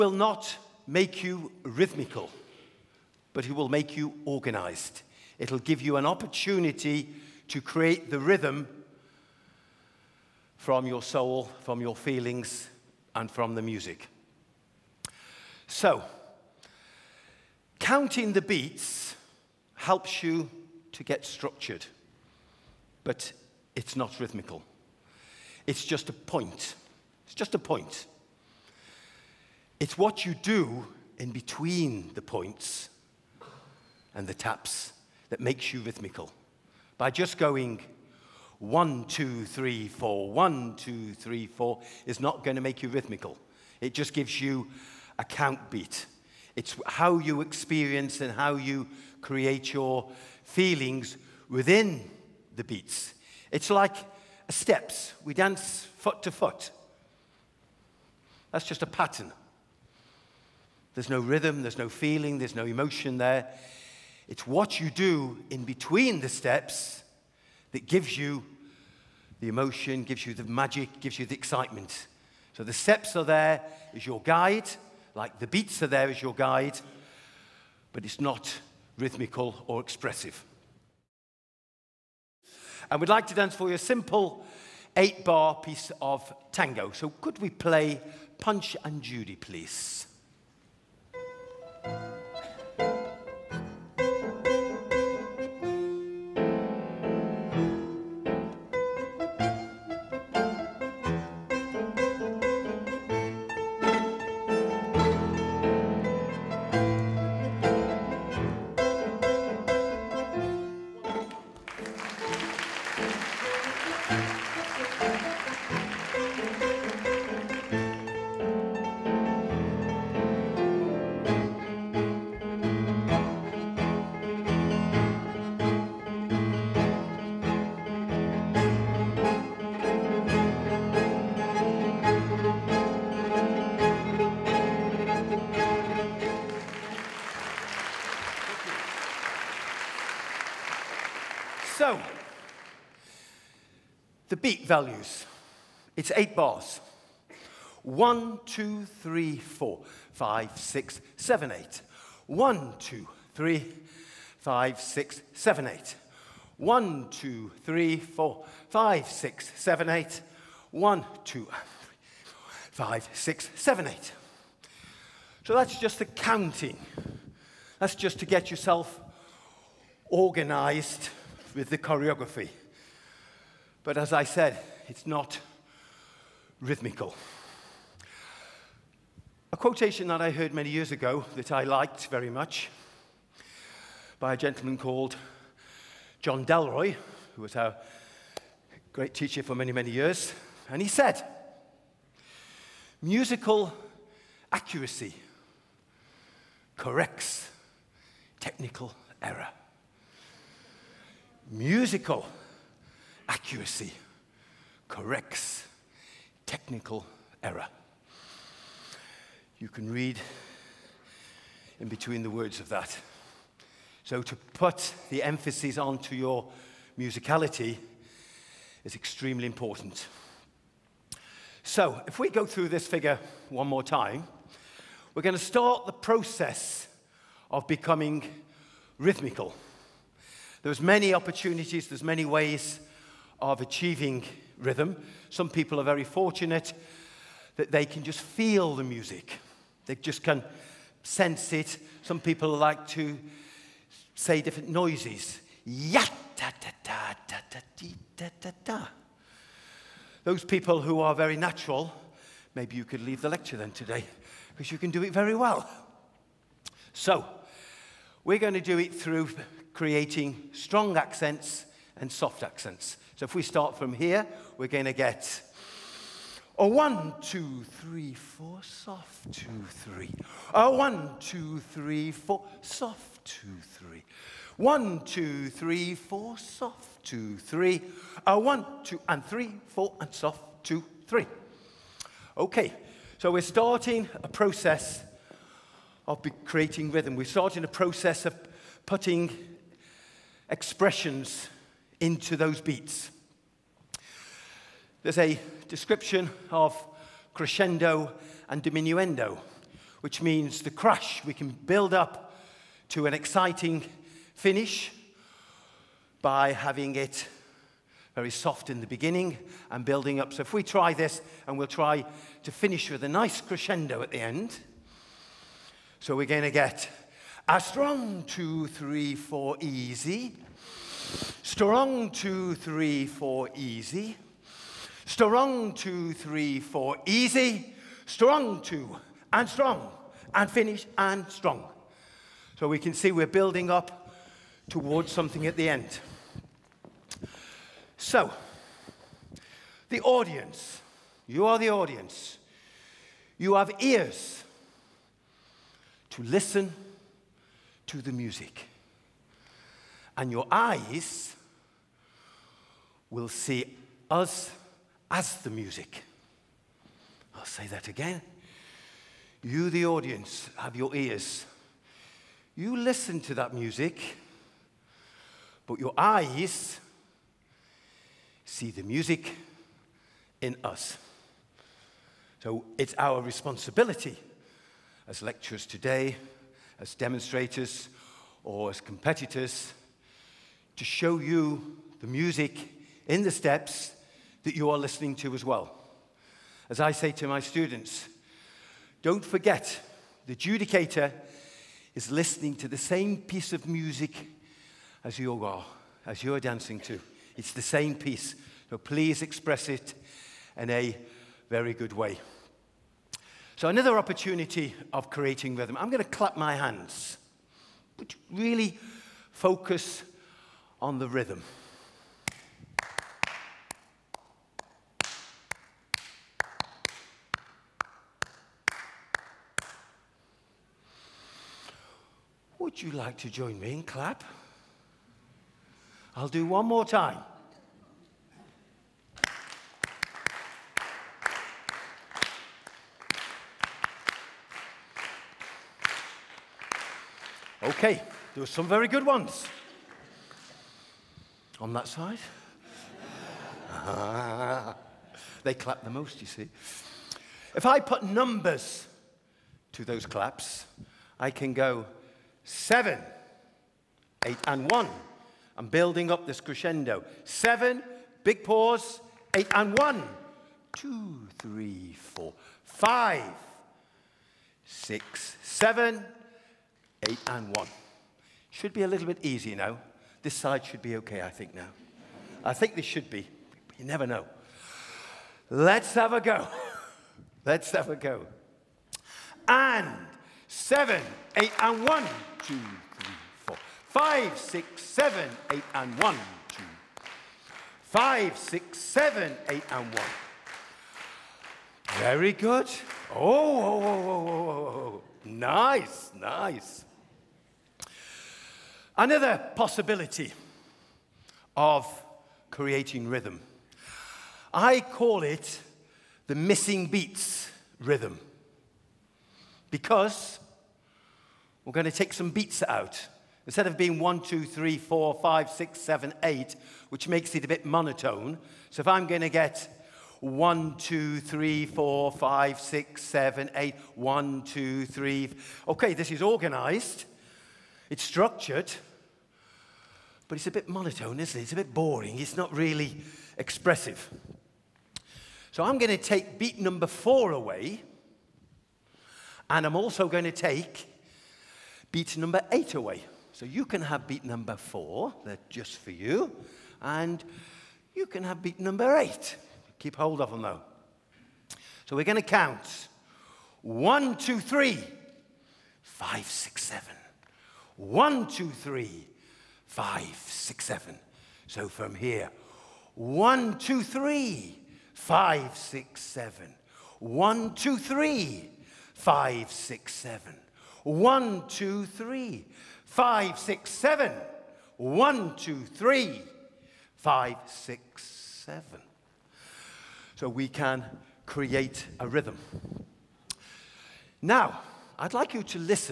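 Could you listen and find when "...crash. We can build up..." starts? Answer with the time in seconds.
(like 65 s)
300 s.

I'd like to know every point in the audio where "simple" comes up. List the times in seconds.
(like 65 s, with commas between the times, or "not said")
83 s.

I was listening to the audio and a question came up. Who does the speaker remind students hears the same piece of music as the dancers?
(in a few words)
the judicator.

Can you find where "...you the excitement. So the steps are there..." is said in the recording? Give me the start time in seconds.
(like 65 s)
71 s.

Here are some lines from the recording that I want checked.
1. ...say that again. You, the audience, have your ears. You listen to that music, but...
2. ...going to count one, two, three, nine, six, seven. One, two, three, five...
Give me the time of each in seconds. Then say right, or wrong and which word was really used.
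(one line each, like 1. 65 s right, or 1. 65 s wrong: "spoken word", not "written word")
1. 357 s right
2. 552 s wrong: "five", not "nine".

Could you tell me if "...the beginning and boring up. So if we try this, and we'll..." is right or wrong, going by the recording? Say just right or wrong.
wrong.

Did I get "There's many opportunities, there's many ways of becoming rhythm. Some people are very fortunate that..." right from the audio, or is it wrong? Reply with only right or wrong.
wrong.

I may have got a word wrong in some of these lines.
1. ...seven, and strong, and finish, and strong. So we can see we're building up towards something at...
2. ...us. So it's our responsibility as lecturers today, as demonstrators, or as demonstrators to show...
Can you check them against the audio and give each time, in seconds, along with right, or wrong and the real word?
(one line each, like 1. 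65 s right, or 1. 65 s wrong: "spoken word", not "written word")
1. 328 s wrong: "two", not "seven"
2. 370 s wrong: "competitors", not "demonstrators".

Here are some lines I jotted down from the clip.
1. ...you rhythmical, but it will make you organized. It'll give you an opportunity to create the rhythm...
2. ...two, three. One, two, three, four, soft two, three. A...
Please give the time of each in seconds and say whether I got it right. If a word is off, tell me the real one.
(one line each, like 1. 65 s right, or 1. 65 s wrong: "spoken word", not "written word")
1. 1 s right
2. 273 s right.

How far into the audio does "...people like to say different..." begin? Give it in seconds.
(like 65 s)
242 s.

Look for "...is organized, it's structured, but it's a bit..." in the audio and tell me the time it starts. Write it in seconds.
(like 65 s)
526 s.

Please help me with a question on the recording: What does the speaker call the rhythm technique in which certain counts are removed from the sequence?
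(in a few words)
missing beats rhythm.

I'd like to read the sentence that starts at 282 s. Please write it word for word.
Okay, so we're starting a process of creating rhythm.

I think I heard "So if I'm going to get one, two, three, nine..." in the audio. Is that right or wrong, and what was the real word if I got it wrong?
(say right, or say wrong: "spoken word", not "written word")
wrong: "four", not "nine".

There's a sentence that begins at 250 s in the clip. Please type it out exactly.
Those people who are very natural, maybe you could leave the lecture then today because you can do it very well.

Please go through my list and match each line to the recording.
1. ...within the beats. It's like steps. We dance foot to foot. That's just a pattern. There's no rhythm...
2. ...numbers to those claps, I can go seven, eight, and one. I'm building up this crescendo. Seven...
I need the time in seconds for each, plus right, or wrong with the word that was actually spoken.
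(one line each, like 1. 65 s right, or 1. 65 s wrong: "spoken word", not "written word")
1. 51 s right
2. 448 s right.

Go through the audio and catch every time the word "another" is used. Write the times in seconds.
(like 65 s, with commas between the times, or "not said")
403 s, 498 s.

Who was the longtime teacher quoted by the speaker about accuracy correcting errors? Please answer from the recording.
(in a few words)
John Delroy.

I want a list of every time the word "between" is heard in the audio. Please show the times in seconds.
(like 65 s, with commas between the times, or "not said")
31 s, 65 s, 211 s.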